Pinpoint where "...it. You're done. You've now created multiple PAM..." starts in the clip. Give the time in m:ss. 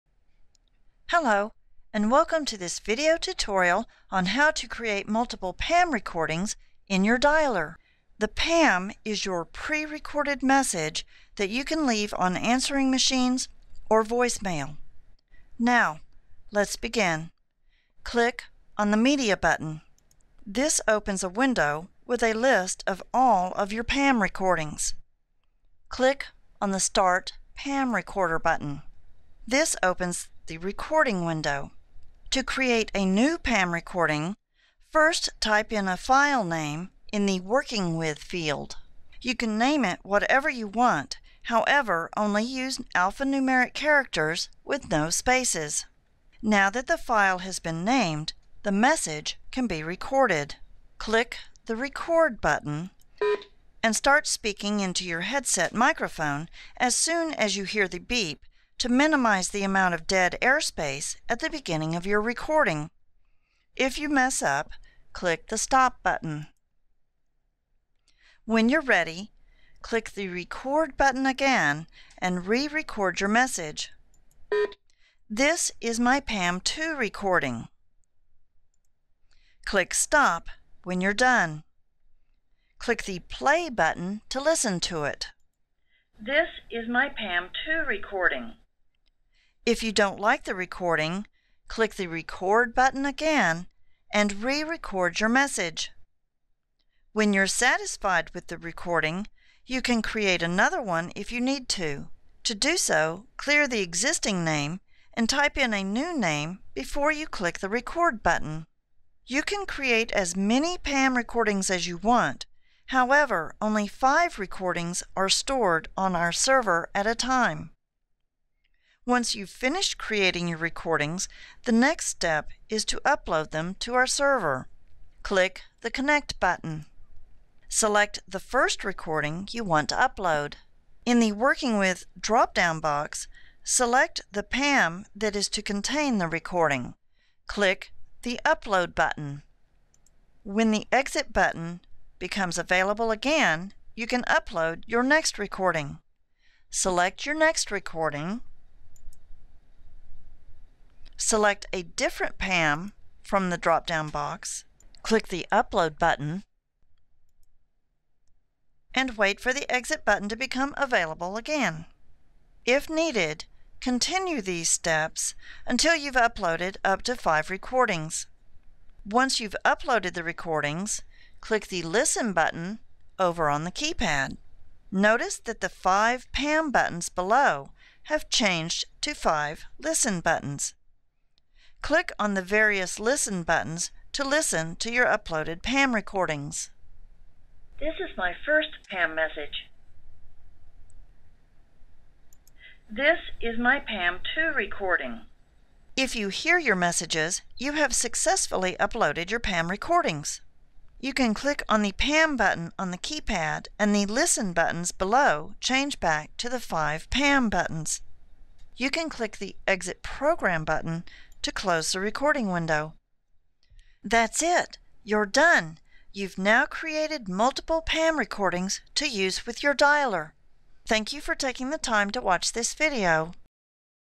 3:34.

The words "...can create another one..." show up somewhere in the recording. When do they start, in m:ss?
1:39.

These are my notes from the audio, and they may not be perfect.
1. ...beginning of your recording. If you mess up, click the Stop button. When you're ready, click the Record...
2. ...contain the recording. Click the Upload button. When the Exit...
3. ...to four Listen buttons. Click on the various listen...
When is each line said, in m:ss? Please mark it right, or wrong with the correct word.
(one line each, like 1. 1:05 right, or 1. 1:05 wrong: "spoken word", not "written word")
1. 1:01 right
2. 2:15 right
3. 2:59 wrong: "five", not "four".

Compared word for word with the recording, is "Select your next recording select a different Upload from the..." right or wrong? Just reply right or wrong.
wrong.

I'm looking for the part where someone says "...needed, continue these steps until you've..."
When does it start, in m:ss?
2:42.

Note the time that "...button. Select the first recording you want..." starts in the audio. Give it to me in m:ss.
2:06.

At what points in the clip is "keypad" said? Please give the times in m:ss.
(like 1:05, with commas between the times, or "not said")
2:53, 3:22.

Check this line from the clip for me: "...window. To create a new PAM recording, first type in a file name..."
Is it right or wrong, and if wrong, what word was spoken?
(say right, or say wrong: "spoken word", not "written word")
right.